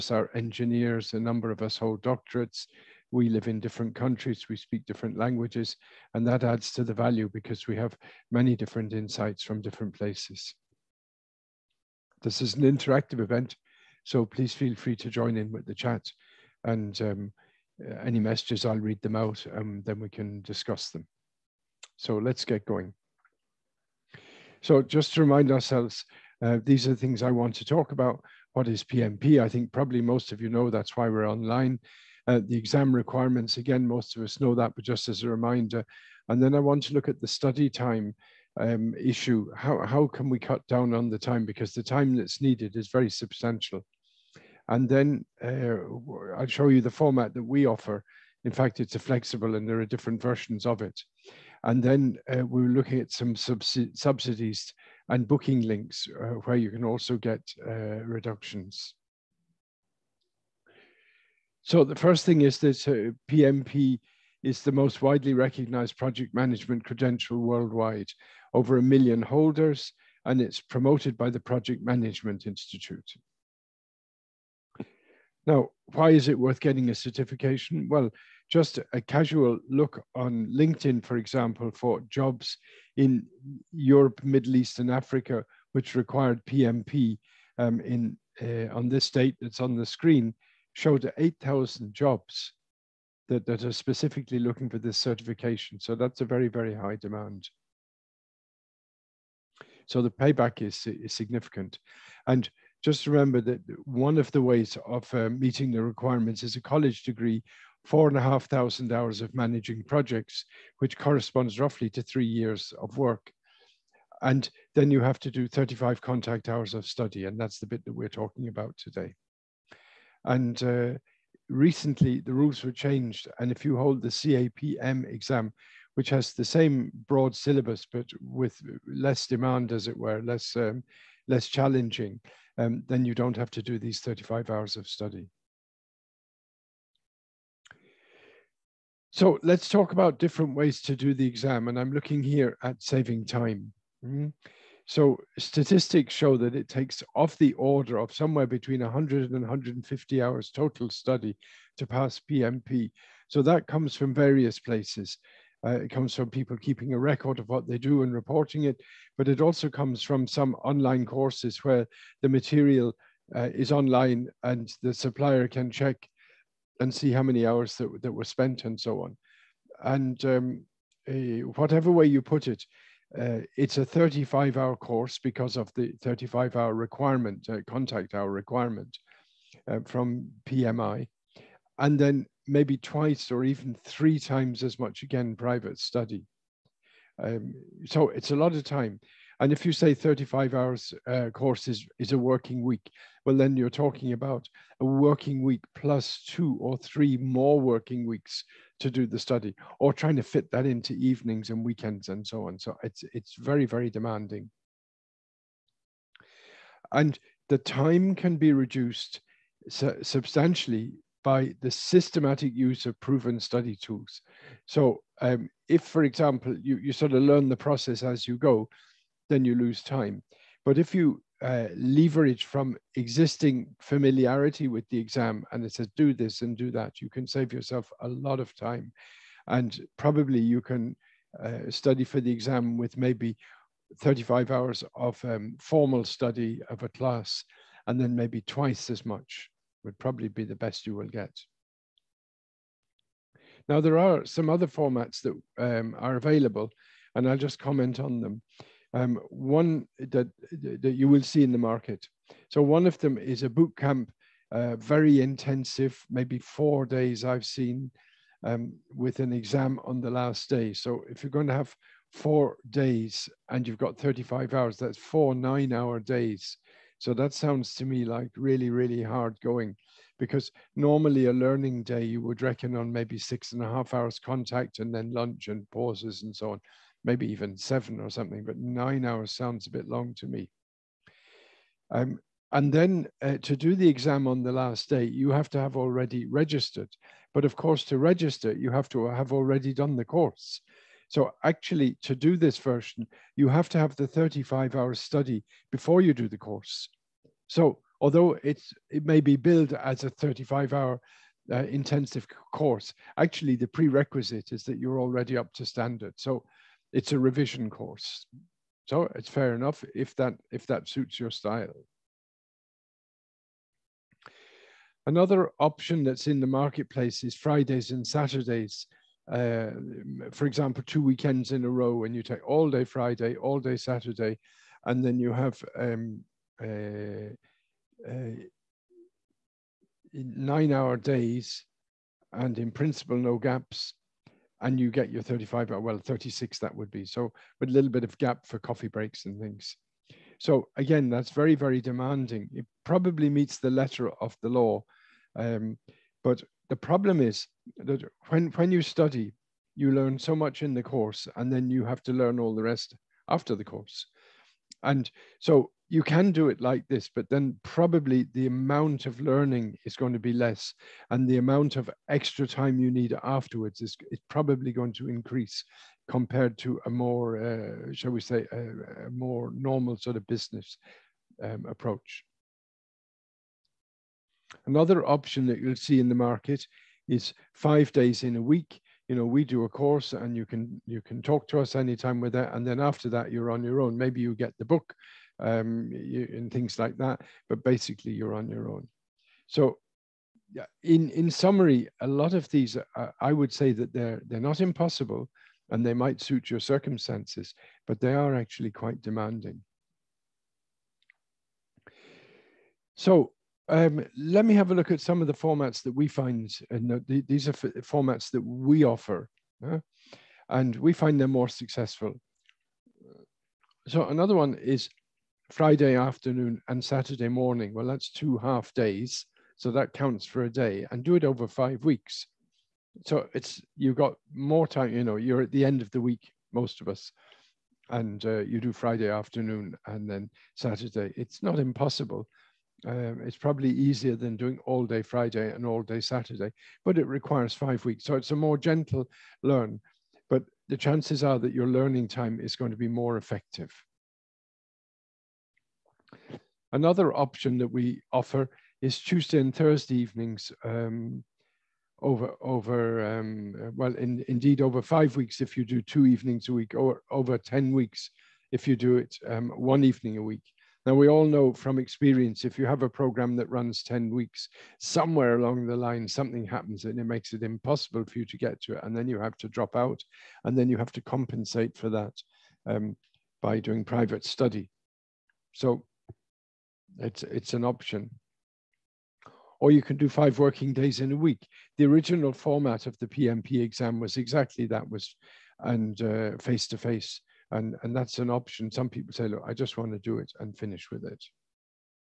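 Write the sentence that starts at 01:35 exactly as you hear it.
So that's a very, very high demand.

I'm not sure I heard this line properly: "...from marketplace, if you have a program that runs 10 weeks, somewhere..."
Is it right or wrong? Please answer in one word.
wrong.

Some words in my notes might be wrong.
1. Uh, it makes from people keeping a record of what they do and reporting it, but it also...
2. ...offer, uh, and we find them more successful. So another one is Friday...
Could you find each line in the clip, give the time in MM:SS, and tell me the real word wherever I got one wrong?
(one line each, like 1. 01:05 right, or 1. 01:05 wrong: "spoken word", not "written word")
1. 02:35 wrong: "comes", not "makes"
2. 06:48 right.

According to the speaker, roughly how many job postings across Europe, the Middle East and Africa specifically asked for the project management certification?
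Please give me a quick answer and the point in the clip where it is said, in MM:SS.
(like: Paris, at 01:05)
8,000, at 01:31.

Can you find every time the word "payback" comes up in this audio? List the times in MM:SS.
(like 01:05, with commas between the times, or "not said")
01:40.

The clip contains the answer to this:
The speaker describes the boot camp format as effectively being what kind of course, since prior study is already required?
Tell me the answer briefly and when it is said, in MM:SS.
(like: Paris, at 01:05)
A revision course, at 05:07.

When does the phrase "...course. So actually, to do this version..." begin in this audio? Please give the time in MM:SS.
04:50.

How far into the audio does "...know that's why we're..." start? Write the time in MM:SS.
00:30.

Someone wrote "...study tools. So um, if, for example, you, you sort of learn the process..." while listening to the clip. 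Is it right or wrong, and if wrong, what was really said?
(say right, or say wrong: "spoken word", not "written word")
right.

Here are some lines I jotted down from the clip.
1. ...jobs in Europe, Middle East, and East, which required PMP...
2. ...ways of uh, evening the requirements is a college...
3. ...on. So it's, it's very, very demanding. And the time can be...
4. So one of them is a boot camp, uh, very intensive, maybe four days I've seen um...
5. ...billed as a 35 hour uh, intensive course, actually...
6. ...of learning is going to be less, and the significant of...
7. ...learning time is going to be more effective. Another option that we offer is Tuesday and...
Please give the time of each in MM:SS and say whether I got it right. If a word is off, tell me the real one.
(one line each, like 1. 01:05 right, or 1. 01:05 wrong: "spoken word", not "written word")
1. 01:22 wrong: "Africa", not "East"
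2. 01:44 wrong: "meeting", not "evening"
3. 03:22 right
4. 04:12 right
5. 04:59 right
6. 05:59 wrong: "amount", not "significant"
7. 07:21 right.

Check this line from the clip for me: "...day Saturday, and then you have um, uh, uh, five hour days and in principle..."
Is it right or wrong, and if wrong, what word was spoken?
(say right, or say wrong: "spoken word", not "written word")
wrong: "nine", not "five".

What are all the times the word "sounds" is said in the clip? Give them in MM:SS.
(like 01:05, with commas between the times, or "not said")
04:27, 04:39.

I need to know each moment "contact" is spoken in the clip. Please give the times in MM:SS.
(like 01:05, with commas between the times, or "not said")
01:56, 02:57, 04:34.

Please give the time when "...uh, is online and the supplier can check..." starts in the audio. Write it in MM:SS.
02:43.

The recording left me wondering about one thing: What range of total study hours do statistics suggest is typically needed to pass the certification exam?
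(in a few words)
100 to 150 hours.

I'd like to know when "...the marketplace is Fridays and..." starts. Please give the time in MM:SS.
05:16.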